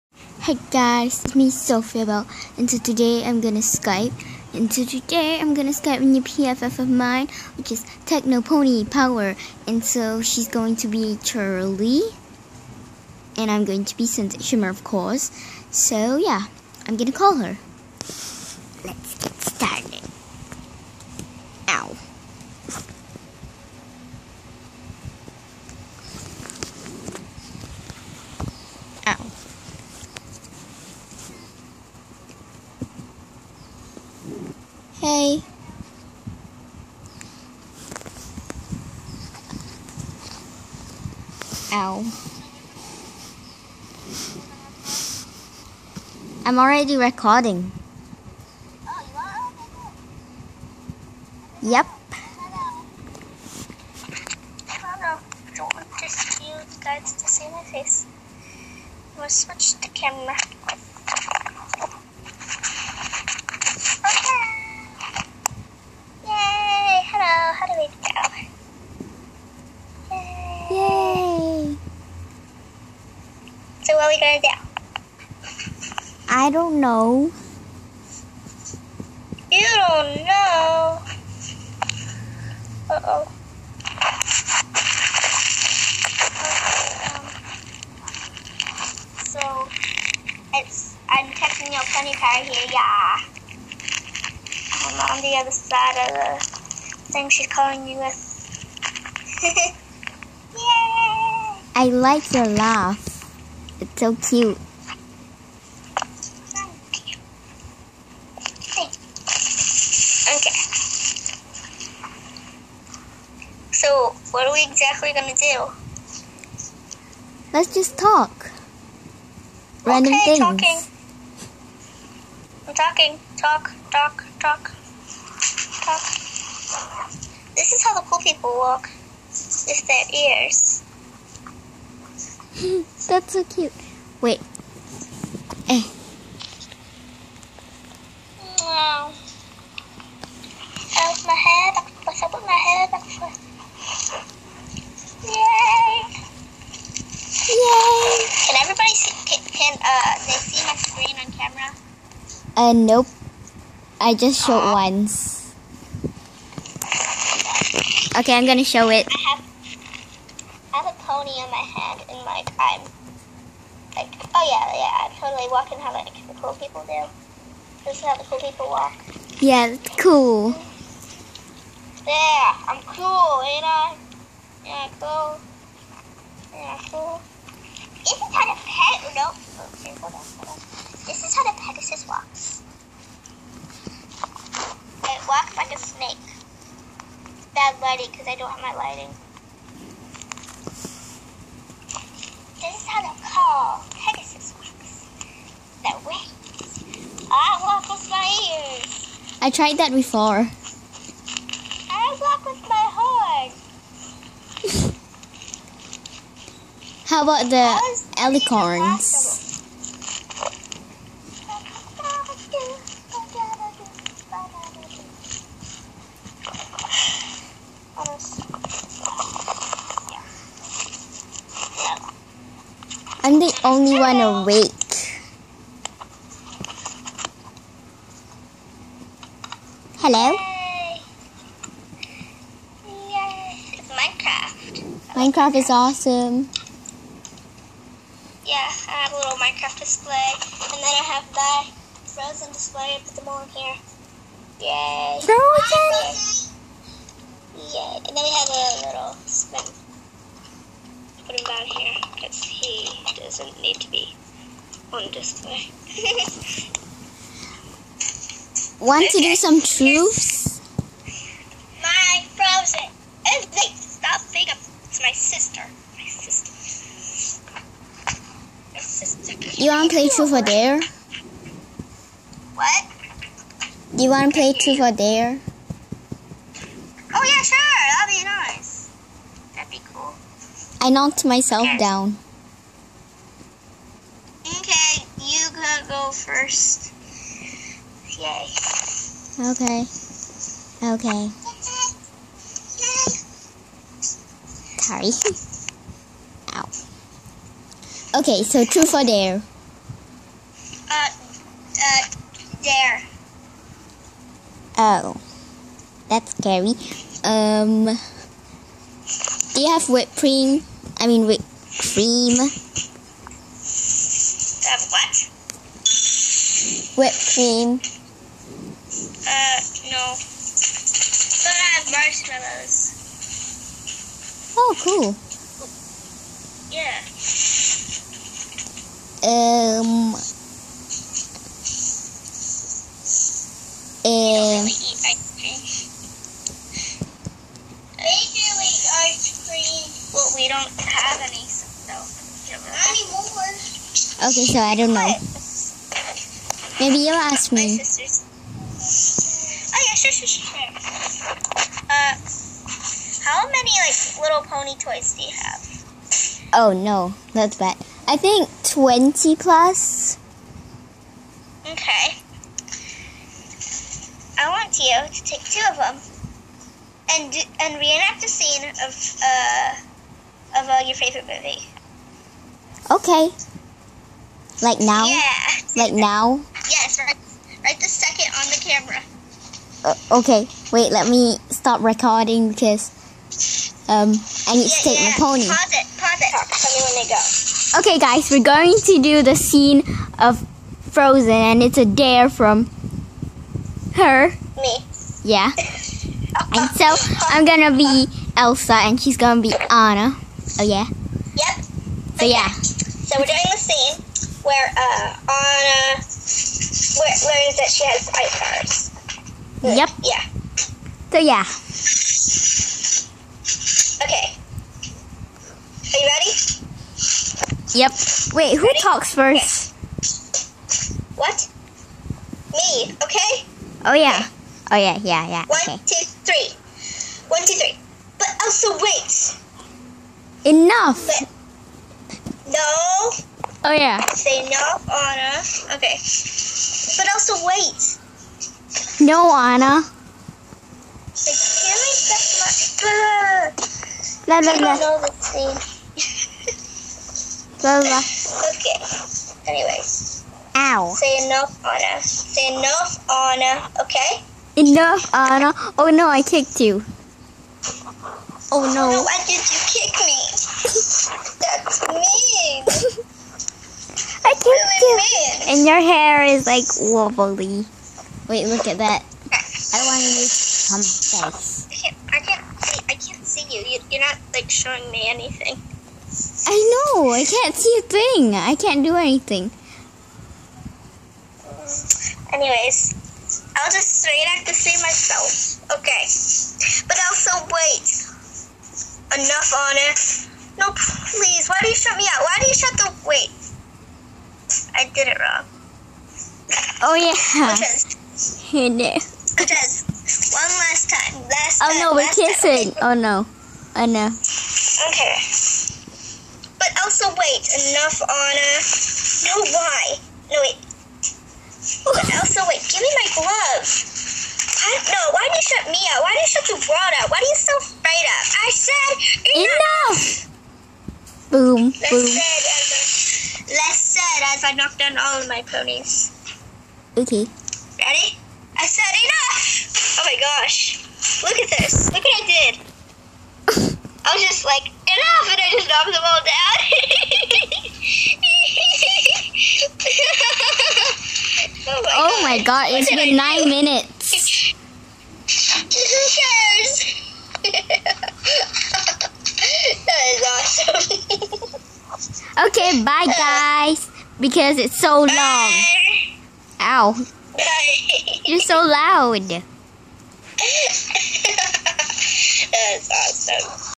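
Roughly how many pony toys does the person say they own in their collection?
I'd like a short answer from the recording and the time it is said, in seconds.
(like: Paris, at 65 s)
20 plus, at 358 s.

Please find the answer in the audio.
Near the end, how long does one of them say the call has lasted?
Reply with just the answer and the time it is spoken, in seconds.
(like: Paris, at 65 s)
9 minutes, at 543 s.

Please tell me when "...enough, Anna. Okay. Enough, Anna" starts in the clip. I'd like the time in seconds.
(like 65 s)
452 s.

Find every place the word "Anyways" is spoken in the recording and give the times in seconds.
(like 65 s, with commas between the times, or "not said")
449 s, 482 s.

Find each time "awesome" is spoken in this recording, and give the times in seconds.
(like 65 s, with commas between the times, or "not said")
235 s, 551 s, 562 s.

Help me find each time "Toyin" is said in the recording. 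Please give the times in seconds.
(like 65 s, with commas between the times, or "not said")
not said.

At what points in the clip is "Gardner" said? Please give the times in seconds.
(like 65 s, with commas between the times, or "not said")
not said.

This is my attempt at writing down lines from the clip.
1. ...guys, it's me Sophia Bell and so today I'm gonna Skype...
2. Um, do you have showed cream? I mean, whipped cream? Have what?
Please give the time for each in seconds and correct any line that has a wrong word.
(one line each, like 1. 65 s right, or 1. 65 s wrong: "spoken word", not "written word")
1. 0 s right
2. 307 s wrong: "whipped", not "showed".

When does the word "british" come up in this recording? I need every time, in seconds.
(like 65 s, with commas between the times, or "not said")
not said.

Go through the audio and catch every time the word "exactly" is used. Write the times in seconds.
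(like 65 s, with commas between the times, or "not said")
114 s.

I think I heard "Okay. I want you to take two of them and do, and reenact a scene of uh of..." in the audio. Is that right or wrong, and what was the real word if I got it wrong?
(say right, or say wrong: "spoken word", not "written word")
right.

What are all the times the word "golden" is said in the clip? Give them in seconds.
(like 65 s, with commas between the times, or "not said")
not said.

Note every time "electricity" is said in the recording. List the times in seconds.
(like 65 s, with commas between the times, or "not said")
not said.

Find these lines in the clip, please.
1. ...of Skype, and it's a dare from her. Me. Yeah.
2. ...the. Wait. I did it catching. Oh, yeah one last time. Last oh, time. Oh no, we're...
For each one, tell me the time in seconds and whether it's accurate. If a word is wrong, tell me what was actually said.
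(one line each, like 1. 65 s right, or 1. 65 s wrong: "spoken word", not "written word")
1. 390 s wrong: "Frozen", not "Skype"
2. 492 s wrong: "wrong", not "catching".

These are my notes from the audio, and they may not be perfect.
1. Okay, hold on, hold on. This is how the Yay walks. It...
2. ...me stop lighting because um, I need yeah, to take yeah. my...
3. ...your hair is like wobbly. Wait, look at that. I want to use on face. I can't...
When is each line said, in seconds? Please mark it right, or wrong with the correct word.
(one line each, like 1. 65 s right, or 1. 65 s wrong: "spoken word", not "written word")
1. 179 s wrong: "Pegasus", not "Yay"
2. 381 s wrong: "recording", not "lighting"
3. 465 s right.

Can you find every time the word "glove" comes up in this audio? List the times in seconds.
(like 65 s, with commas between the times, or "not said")
513 s.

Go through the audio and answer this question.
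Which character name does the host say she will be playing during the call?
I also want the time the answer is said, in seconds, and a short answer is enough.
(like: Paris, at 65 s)
Shimmer, at 14 s.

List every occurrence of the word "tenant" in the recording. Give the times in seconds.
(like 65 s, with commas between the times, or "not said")
not said.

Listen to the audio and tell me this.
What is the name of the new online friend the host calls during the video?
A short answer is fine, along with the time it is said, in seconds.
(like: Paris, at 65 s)
Techno Pony Power, at 8 s.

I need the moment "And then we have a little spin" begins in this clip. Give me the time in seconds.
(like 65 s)
247 s.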